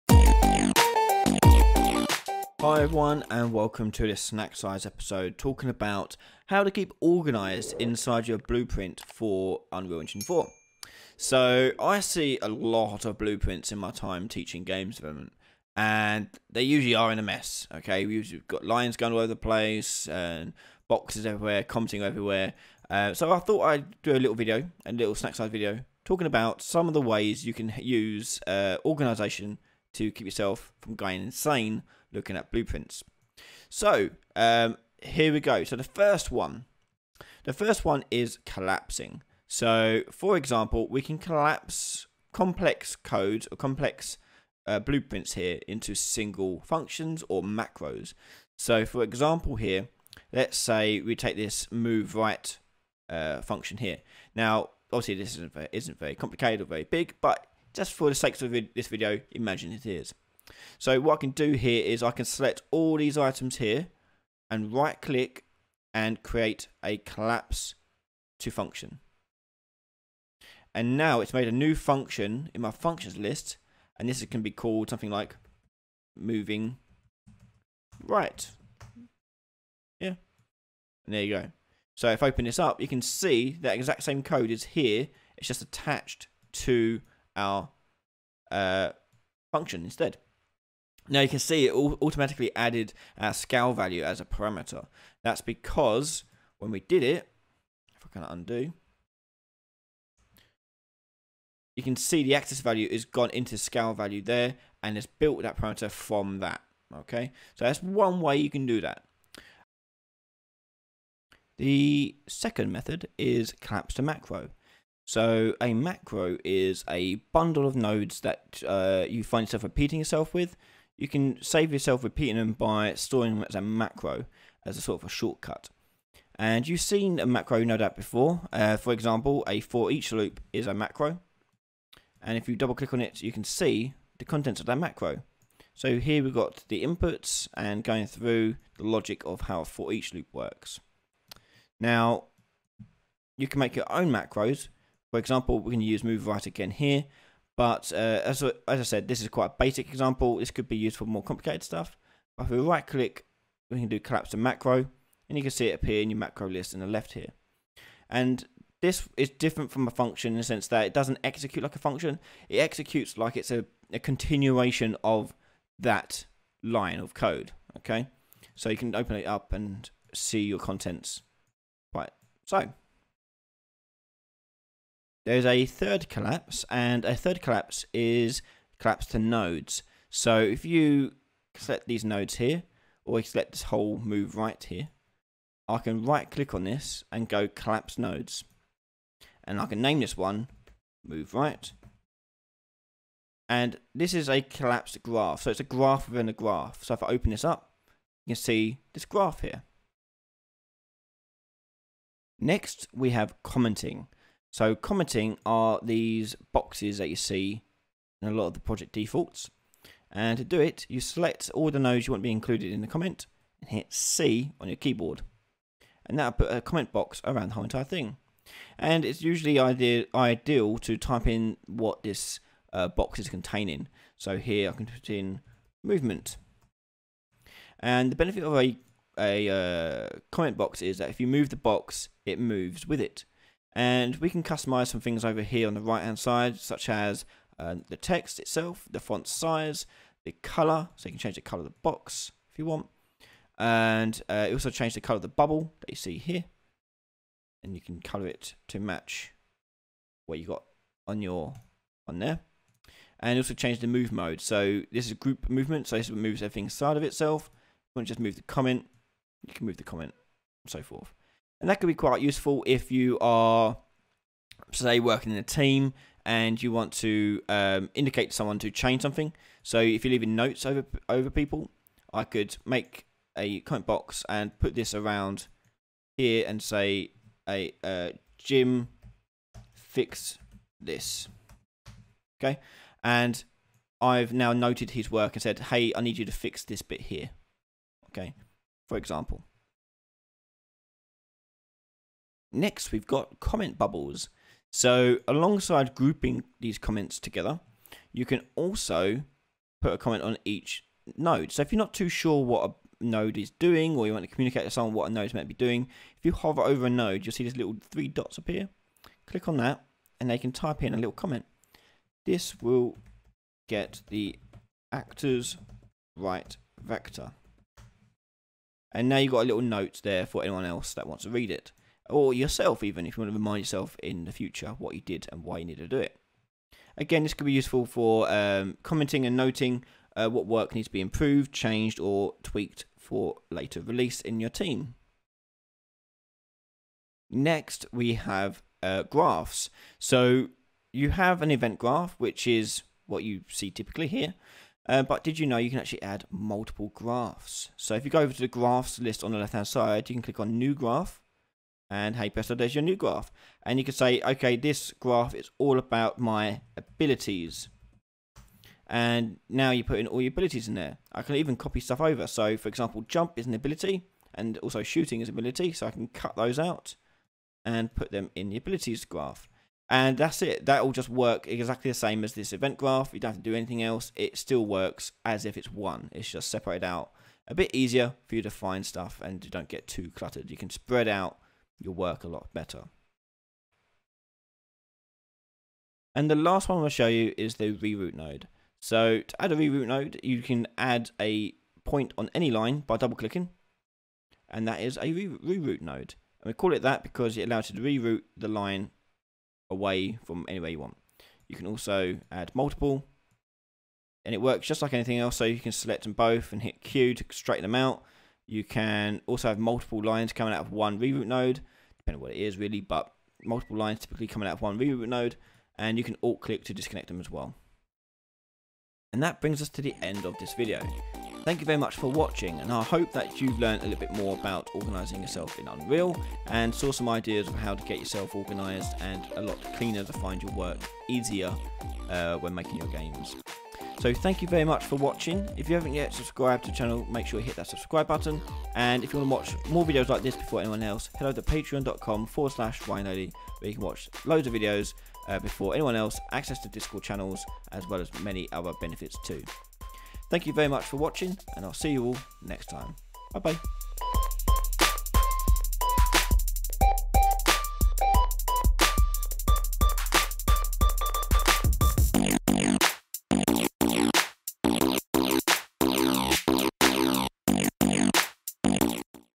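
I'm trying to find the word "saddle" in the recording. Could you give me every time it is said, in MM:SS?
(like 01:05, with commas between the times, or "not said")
not said.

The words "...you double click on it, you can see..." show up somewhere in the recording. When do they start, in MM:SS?
02:12.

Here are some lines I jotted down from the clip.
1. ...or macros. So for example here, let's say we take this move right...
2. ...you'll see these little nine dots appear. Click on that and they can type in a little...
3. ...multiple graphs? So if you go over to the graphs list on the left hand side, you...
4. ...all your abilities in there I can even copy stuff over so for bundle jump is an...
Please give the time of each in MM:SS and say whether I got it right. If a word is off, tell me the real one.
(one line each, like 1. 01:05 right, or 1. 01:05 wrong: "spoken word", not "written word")
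1. 00:47 right
2. 05:07 wrong: "three", not "nine"
3. 05:46 right
4. 06:00 wrong: "example", not "bundle".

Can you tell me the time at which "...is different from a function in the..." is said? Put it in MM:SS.
02:39.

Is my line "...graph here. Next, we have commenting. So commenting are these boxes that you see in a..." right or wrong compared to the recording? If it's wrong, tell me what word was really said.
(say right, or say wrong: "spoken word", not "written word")
right.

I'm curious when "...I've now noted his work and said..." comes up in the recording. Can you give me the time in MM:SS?
04:44.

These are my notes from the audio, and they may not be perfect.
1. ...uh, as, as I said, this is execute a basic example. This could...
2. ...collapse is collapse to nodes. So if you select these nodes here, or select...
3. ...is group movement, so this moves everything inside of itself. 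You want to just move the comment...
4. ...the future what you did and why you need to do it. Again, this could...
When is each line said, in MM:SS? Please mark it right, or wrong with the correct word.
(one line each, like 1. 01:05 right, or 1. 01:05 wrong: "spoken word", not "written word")
1. 02:27 wrong: "quite", not "execute"
2. 02:57 right
3. 04:15 right
4. 05:24 right.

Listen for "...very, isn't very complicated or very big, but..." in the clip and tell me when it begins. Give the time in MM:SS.
00:55.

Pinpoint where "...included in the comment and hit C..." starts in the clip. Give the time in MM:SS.
03:32.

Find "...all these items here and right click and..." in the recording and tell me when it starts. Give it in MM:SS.
01:02.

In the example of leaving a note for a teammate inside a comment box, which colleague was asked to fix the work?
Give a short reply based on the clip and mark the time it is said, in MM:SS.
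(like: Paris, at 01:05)
Jim, at 04:38.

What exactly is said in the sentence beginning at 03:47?
And the benefit of a, a uh, comment box is that if you move the box, it moves with it.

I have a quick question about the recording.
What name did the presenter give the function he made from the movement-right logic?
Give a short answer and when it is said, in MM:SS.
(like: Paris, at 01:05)
moving right, at 01:16.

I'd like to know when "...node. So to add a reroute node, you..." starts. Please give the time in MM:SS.
06:28.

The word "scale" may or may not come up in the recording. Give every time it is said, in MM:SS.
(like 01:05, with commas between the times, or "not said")
01:33, 01:43.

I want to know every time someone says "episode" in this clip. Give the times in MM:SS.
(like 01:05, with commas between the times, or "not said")
00:04.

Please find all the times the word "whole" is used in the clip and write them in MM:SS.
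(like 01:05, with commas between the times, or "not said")
03:03, 03:37.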